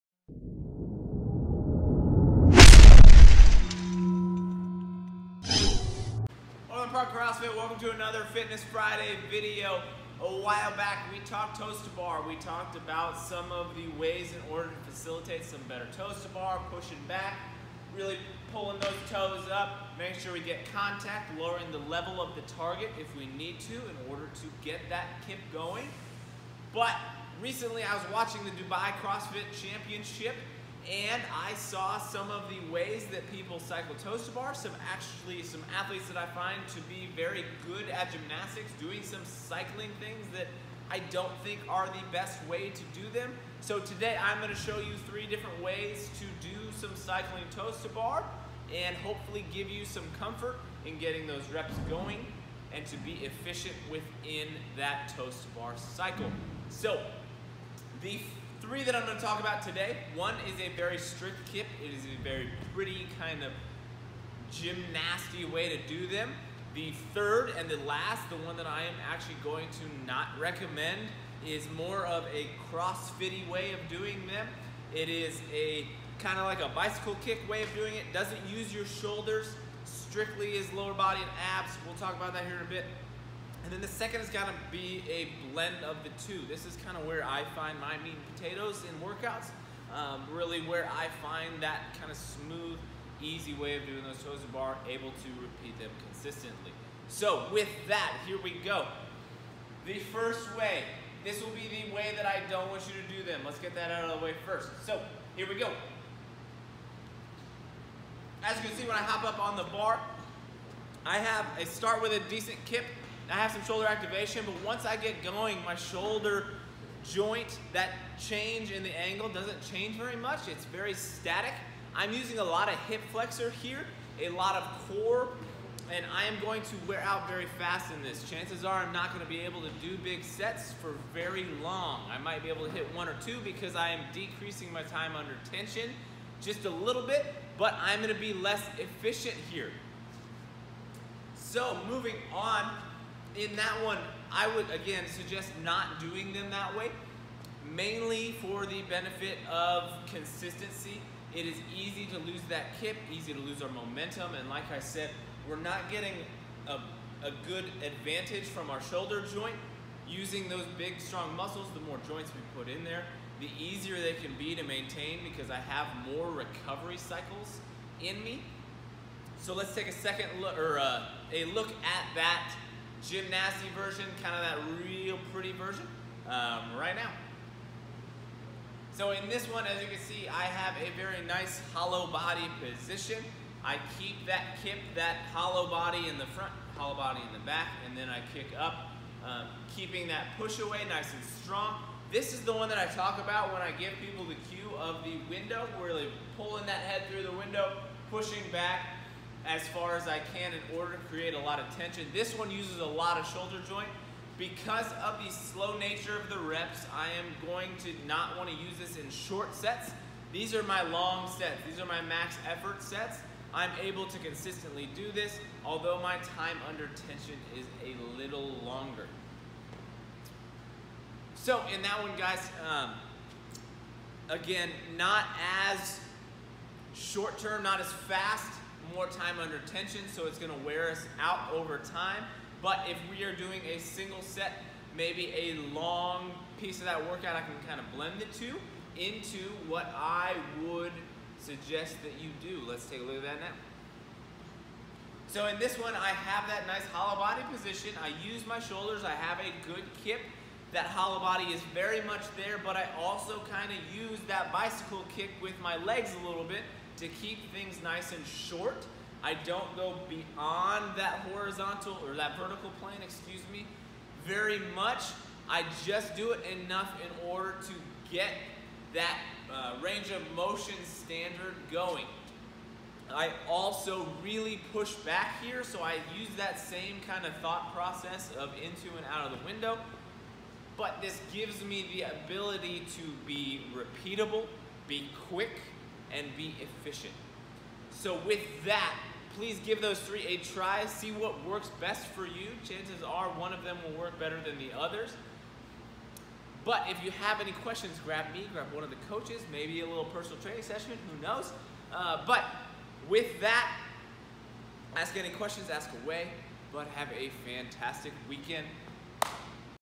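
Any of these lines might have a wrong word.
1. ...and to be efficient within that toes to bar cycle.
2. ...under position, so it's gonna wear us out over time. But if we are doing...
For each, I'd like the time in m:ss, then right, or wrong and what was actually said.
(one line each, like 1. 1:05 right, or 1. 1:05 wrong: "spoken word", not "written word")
1. 0:52 right
2. 3:49 wrong: "tension", not "position".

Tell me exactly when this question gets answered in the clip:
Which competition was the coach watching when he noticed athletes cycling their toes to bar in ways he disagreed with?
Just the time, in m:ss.
0:28.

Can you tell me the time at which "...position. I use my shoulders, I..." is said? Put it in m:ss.
4:07.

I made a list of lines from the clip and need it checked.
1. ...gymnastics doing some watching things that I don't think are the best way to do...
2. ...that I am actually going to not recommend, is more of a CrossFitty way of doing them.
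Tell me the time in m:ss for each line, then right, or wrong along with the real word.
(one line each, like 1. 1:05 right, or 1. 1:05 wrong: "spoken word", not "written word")
1. 0:38 wrong: "cycling", not "watching"
2. 1:08 right.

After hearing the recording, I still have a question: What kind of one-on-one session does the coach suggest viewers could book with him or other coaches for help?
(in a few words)
Personal training session.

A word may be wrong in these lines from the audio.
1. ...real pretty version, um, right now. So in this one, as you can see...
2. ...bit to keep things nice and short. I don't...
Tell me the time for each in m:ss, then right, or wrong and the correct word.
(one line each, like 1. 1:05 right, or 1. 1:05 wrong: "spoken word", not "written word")
1. 2:54 right
2. 4:16 right.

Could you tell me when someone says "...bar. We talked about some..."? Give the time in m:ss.
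0:11.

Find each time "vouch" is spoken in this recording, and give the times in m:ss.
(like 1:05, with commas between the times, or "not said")
not said.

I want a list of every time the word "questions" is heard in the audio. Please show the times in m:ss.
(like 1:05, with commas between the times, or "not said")
4:57, 5:05.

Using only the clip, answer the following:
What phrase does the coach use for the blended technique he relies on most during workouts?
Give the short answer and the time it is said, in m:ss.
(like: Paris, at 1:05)
Meat and potatoes, at 1:28.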